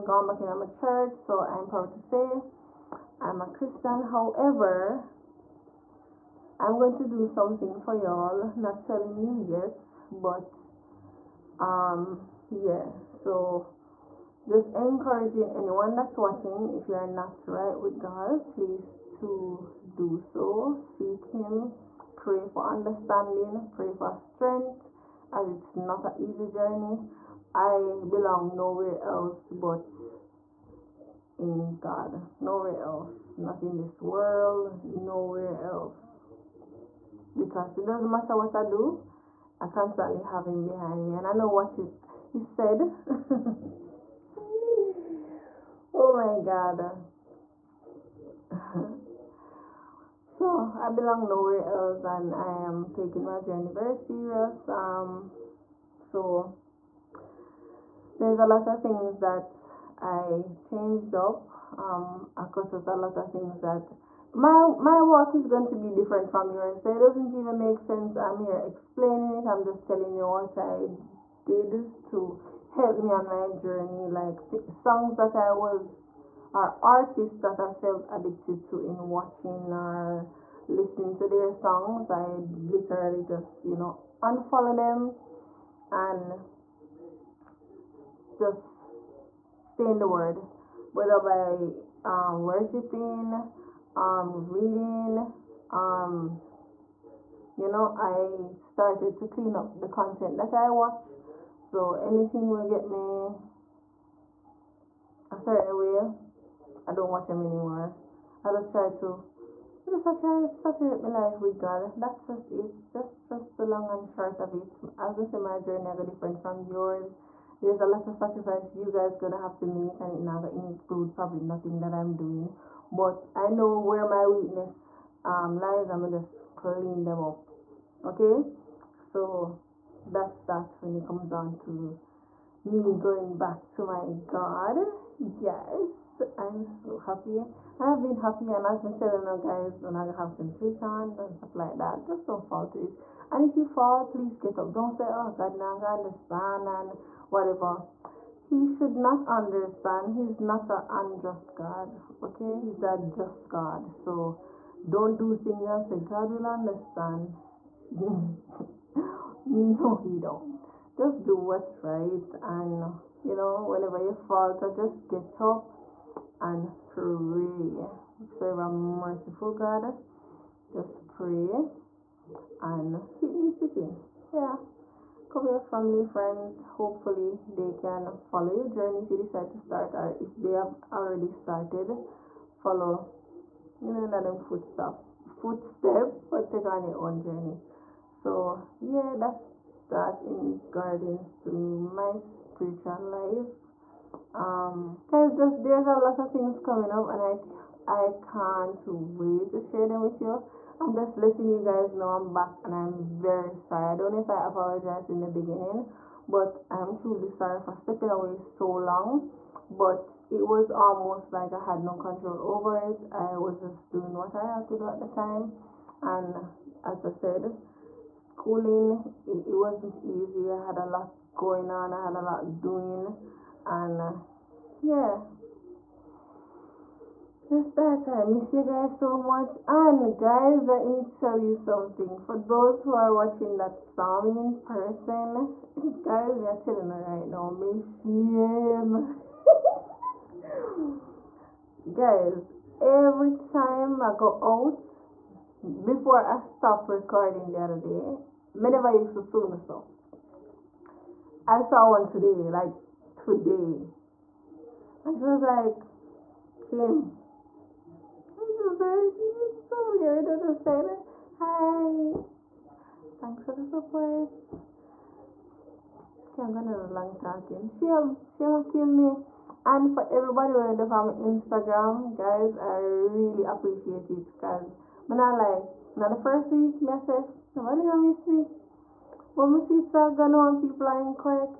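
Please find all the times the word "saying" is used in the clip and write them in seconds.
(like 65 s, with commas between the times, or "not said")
258 s.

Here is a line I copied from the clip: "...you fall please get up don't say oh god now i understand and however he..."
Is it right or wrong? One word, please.
wrong.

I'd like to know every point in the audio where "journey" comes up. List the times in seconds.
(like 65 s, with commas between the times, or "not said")
26 s, 53 s, 73 s, 115 s, 178 s, 187 s.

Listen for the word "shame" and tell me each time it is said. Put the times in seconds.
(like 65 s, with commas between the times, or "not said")
237 s, 267 s.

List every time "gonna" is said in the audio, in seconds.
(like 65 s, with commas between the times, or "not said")
119 s, 126 s, 279 s.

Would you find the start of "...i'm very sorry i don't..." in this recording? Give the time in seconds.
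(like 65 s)
202 s.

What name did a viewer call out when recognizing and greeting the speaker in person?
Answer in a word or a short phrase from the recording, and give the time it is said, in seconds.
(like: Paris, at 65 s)
Kim, at 256 s.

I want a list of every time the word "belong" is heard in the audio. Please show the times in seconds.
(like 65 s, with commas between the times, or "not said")
28 s, 50 s.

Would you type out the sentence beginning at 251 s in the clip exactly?
I saw one today, like today.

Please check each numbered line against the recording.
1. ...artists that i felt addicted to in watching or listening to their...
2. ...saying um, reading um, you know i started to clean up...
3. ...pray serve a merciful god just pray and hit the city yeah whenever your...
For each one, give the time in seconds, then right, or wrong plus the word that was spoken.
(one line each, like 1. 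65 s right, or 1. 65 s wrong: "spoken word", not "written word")
1. 76 s right
2. 92 s wrong: "worshiping", not "saying"
3. 166 s wrong: "cover", not "whenever".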